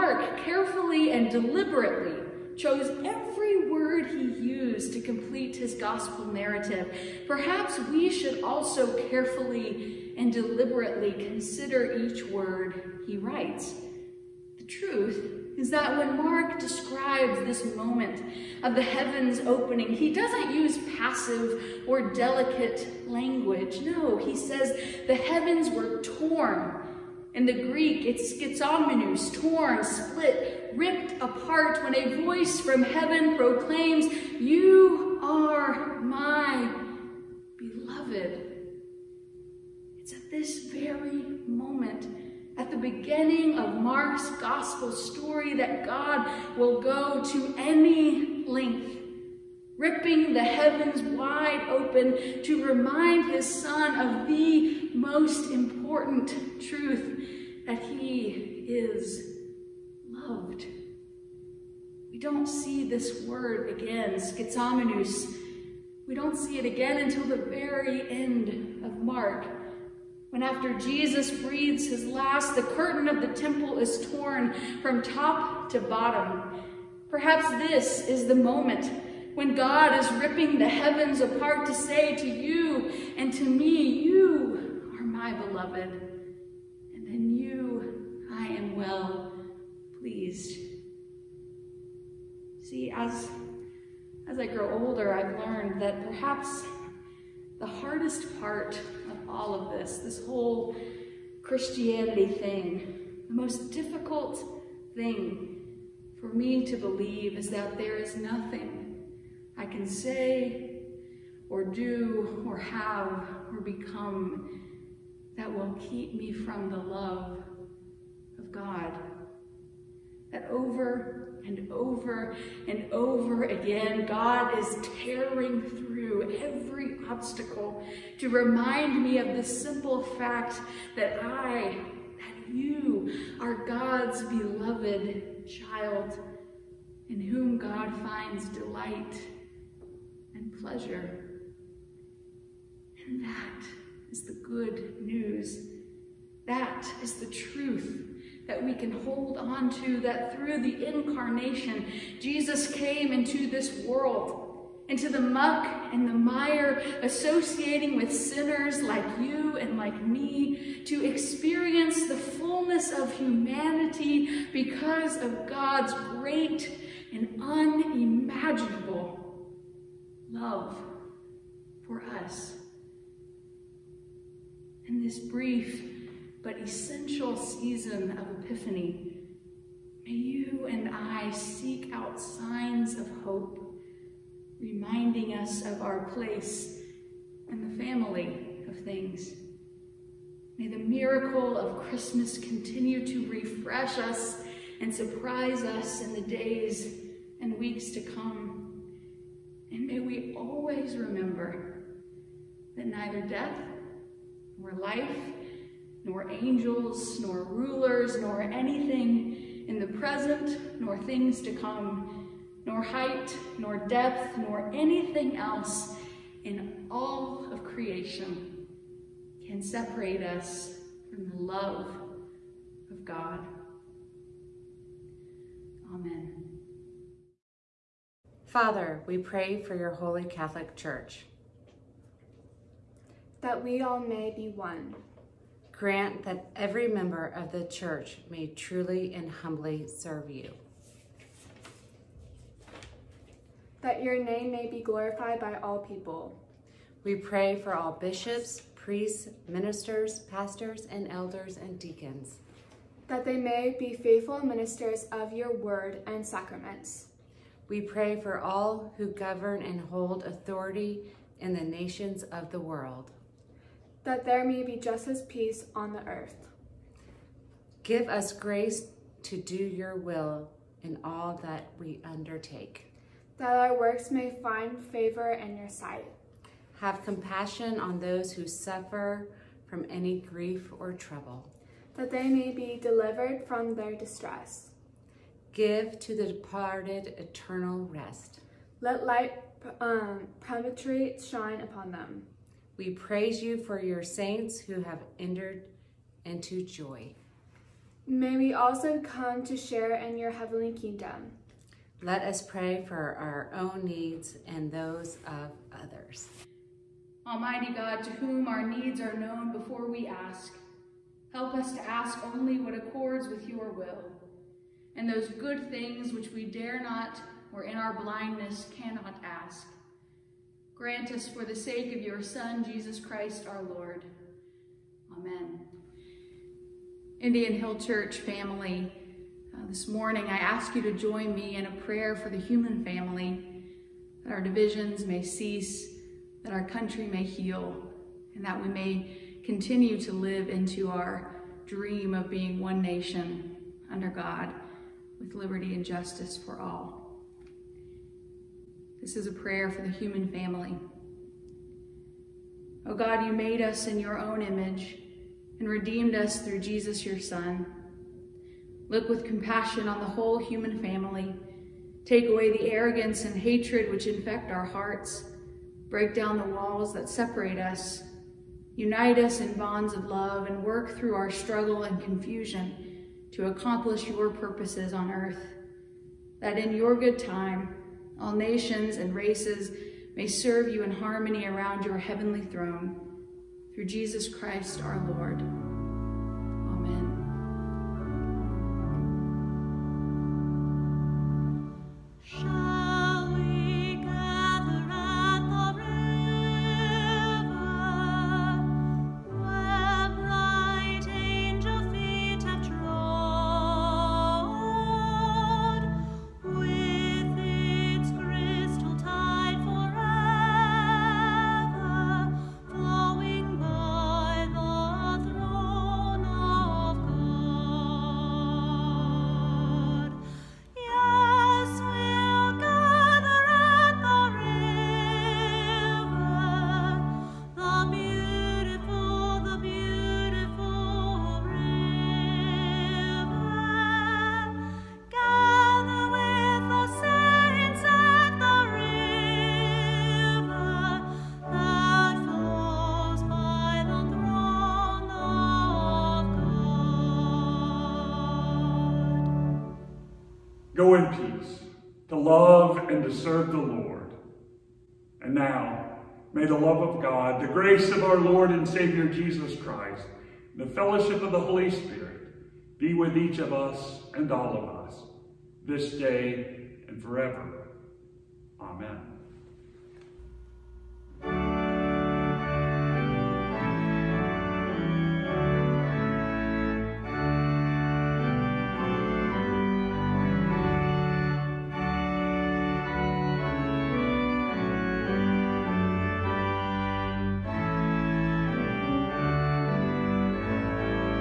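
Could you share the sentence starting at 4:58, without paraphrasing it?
May we also come to share in your heavenly kingdom.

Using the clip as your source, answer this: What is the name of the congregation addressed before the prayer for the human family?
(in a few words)
Indian Hill Church.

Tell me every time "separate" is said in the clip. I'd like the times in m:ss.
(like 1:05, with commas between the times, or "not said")
3:39, 6:07.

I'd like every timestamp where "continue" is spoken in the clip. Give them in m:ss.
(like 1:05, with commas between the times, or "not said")
3:12, 5:39.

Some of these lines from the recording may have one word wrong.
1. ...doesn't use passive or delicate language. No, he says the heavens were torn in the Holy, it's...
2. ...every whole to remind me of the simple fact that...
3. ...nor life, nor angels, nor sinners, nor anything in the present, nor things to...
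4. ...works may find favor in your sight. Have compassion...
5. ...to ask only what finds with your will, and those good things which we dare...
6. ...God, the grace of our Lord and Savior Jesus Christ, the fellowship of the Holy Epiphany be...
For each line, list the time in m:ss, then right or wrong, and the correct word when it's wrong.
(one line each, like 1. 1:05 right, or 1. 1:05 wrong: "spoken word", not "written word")
1. 0:20 wrong: "Greek", not "Holy"
2. 2:06 wrong: "obstacle", not "whole"
3. 3:24 wrong: "rulers", not "sinners"
4. 4:33 right
5. 5:11 wrong: "accords", not "finds"
6. 7:37 wrong: "Spirit", not "Epiphany".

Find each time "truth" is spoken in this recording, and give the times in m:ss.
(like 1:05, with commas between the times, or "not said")
0:14, 0:56, 2:27.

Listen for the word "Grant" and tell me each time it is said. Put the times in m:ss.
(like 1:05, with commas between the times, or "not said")
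3:55, 5:20.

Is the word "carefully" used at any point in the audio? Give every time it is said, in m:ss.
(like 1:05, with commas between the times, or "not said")
0:00, 0:09.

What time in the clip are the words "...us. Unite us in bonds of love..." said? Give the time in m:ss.
6:07.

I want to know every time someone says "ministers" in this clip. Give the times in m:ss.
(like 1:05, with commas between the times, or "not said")
4:09, 4:14.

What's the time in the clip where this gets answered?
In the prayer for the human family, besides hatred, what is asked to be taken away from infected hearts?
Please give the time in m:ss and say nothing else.
6:02.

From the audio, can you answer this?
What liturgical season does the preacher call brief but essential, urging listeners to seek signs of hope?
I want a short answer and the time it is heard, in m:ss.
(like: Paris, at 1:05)
Epiphany, at 2:58.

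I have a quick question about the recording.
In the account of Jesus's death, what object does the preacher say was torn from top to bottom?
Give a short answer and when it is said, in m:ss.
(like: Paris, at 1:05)
The curtain of the temple, at 1:12.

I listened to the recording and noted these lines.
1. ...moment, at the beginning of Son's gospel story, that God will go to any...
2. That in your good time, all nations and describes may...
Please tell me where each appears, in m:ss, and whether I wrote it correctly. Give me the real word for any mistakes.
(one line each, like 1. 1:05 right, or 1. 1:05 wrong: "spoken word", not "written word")
1. 0:41 wrong: "Mark", not "Son"
2. 6:16 wrong: "races", not "describes".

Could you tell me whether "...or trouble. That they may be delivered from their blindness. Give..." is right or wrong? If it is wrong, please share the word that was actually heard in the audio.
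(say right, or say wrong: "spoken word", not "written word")
wrong: "distress", not "blindness".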